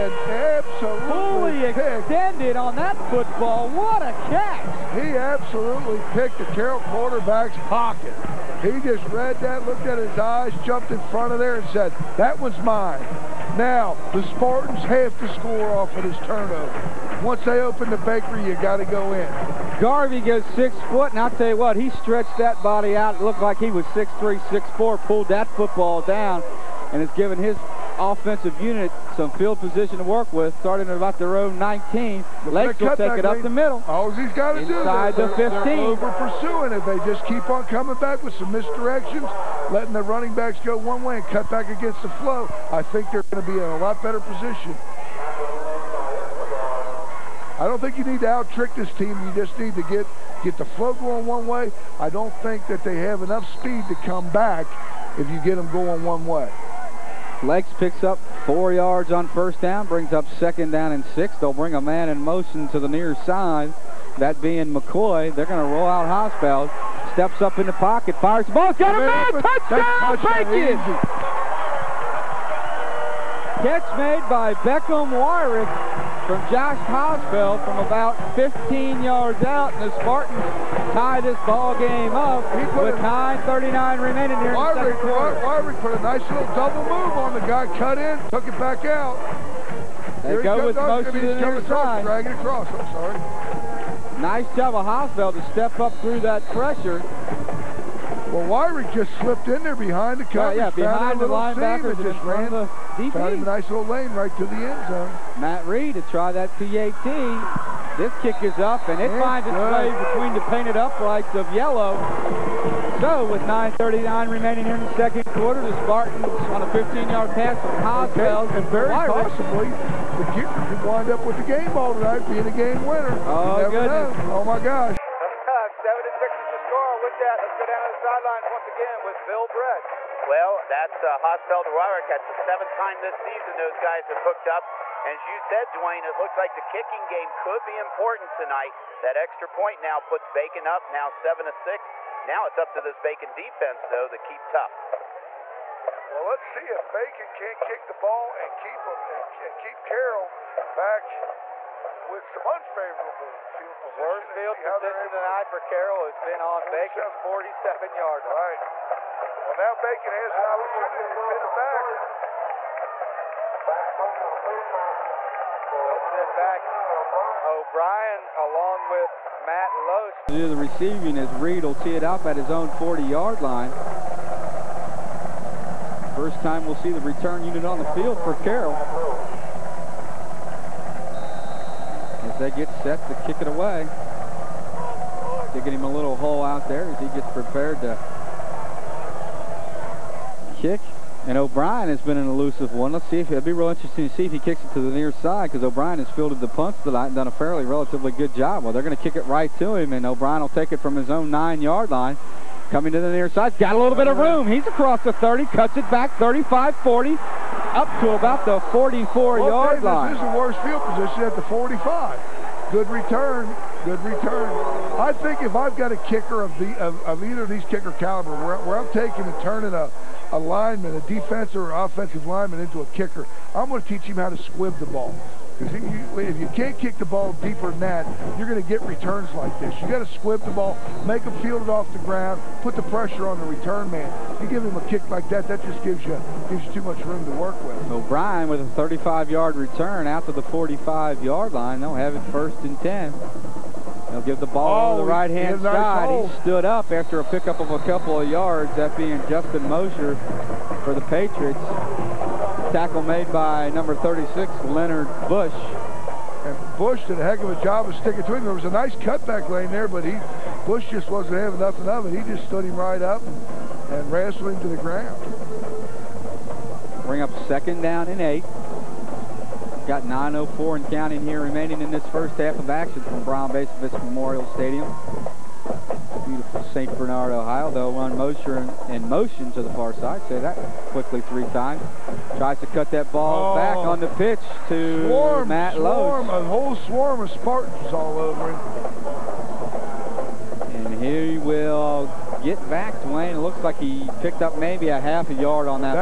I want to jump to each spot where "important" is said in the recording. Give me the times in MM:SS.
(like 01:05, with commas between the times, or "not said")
02:17.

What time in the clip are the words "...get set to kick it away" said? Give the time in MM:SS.
03:02.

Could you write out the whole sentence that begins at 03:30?
This is the worst field position at the 45.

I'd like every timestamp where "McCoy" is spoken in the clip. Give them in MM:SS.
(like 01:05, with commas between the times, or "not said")
01:04.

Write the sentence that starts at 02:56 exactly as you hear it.
First time we'll see the return unit on the field for Carroll.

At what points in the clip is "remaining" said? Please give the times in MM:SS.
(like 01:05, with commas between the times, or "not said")
01:24, 01:54, 04:31.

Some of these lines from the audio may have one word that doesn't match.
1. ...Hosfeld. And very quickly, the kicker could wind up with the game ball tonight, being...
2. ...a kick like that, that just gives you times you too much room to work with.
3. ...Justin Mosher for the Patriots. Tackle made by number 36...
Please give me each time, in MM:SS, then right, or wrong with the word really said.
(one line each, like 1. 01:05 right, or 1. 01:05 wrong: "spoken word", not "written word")
1. 01:57 wrong: "possibly", not "quickly"
2. 03:54 wrong: "gives", not "times"
3. 04:09 right.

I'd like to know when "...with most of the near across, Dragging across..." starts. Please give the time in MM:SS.
01:30.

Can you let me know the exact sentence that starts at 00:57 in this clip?
Lakes picks up four yards on first down, brings up second down and six.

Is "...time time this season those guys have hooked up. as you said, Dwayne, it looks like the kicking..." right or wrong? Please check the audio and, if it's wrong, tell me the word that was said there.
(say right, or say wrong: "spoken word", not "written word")
right.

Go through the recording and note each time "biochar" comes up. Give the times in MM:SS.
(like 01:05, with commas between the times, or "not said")
not said.